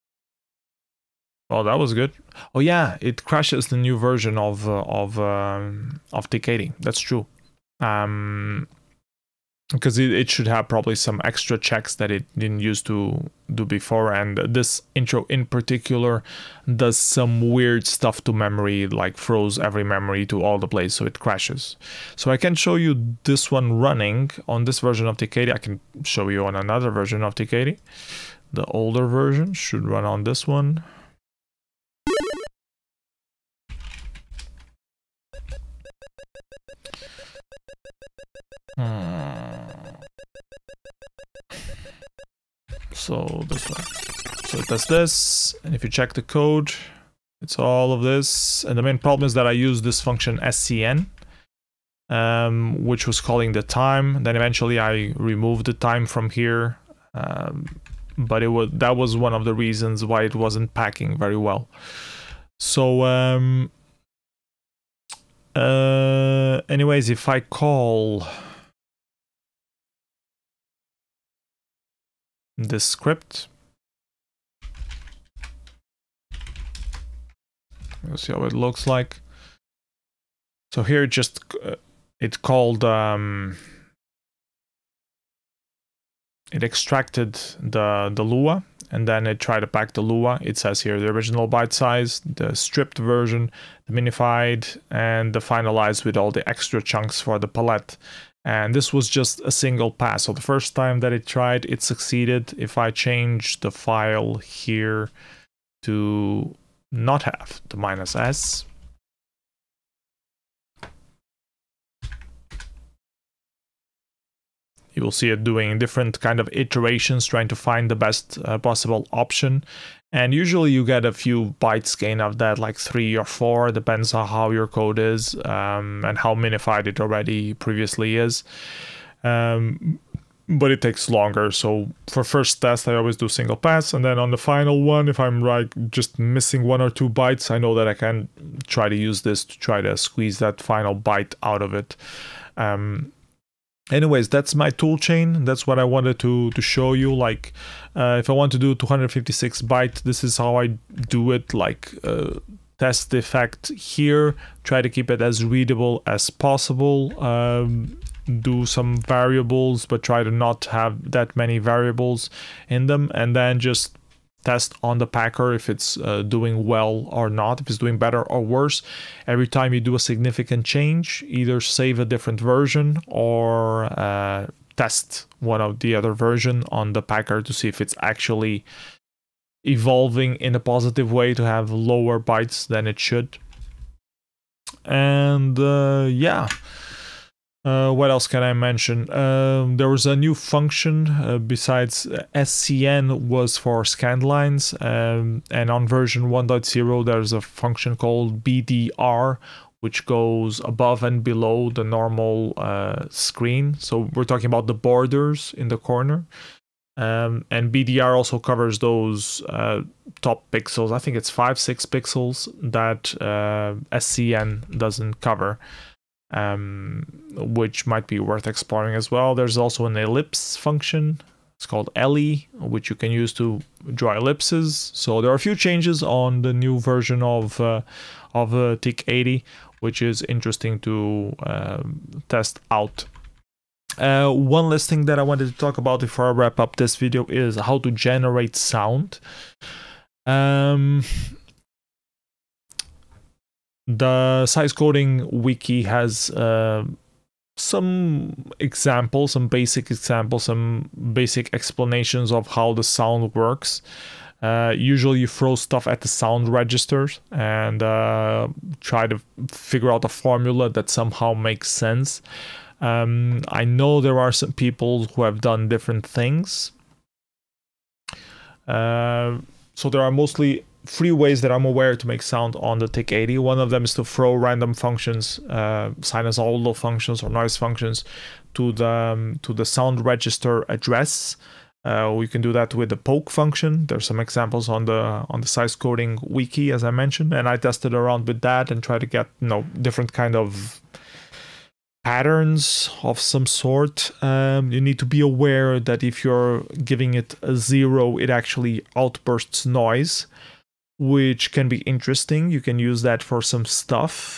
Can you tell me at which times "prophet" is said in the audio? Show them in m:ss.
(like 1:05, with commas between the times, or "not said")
not said.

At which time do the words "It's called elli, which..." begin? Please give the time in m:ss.
3:41.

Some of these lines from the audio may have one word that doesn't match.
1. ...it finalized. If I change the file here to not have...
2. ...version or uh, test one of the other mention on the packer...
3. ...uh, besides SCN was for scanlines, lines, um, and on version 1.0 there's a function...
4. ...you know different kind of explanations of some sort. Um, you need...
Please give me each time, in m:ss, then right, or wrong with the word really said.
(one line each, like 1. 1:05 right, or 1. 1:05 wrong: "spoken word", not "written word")
1. 1:41 wrong: "succeeded", not "finalized"
2. 2:52 wrong: "version", not "mention"
3. 3:11 right
4. 4:49 wrong: "patterns", not "explanations".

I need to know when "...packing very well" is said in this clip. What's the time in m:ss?
1:00.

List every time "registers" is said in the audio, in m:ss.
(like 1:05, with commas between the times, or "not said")
4:16, 4:40.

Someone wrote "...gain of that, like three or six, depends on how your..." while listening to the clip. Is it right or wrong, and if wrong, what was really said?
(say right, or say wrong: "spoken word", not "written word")
wrong: "four", not "six".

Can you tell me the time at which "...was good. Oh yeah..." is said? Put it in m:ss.
0:01.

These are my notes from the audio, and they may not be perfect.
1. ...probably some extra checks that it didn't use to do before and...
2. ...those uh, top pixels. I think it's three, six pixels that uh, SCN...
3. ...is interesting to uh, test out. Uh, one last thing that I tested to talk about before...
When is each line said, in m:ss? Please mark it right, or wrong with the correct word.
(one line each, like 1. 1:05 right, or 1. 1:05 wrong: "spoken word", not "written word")
1. 0:10 right
2. 3:28 wrong: "five", not "three"
3. 3:50 wrong: "wanted", not "tested".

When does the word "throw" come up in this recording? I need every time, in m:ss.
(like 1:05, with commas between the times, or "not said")
4:15, 4:34.